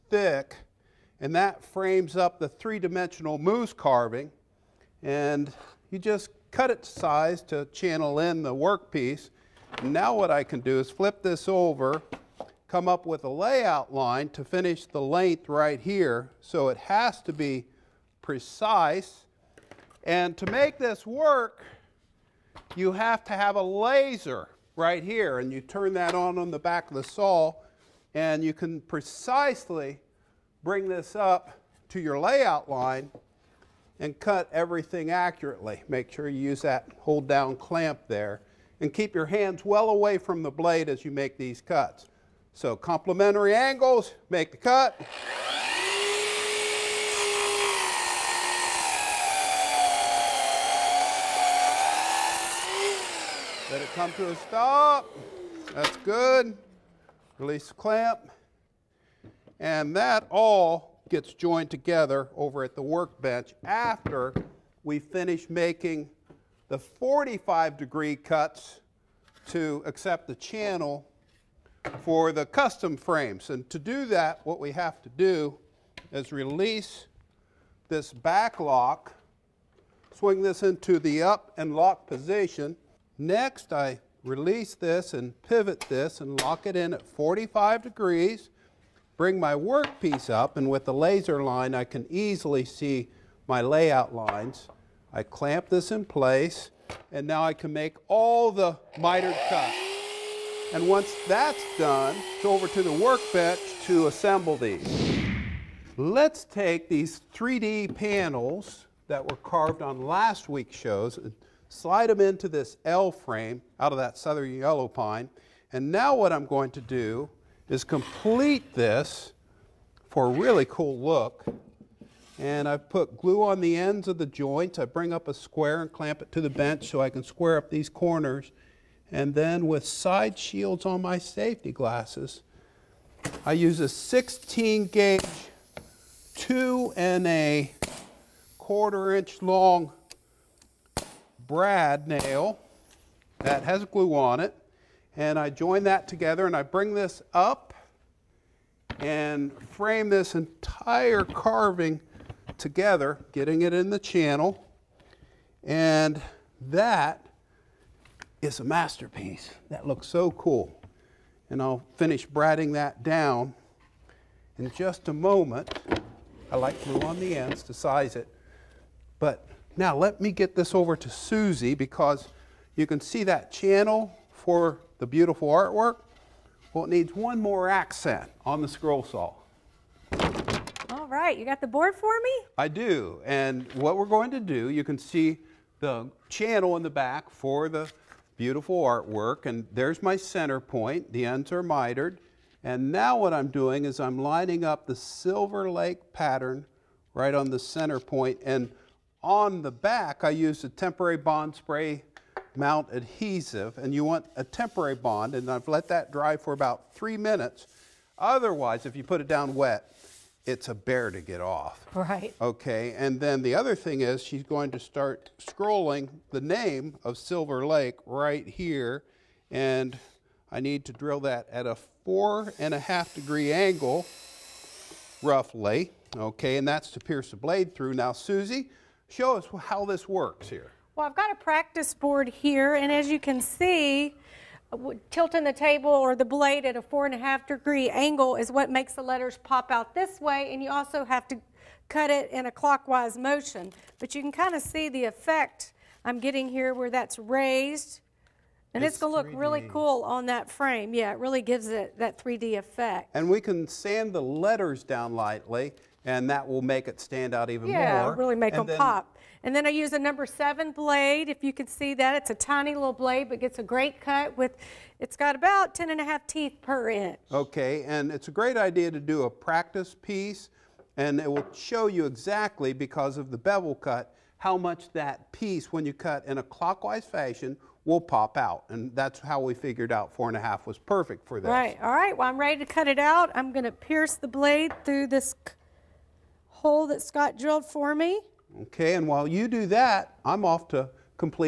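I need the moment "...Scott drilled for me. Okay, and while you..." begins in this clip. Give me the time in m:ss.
4:47.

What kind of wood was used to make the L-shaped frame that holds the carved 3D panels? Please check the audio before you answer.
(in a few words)
southern yellow pine.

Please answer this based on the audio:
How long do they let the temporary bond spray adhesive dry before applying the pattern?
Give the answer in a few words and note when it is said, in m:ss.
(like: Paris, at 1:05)
about 3 minutes, at 3:26.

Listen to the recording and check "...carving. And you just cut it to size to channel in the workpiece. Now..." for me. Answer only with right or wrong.
right.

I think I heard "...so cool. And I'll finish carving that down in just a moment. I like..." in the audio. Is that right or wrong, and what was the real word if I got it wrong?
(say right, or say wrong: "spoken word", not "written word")
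wrong: "bratting", not "carving".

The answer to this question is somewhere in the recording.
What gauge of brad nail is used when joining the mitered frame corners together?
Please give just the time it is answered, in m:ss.
2:13.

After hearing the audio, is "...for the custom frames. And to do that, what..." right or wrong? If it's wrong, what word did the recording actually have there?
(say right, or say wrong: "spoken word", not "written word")
right.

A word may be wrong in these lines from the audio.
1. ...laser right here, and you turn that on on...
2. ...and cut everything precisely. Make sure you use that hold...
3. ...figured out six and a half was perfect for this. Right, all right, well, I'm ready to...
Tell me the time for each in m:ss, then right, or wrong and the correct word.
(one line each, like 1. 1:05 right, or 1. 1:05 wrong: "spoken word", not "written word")
1. 0:23 right
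2. 0:33 wrong: "accurately", not "precisely"
3. 4:39 wrong: "four", not "six".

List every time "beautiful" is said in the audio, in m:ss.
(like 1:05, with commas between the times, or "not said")
2:55, 3:08.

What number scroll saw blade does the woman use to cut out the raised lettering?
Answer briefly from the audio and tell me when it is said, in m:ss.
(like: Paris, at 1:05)
7, at 4:19.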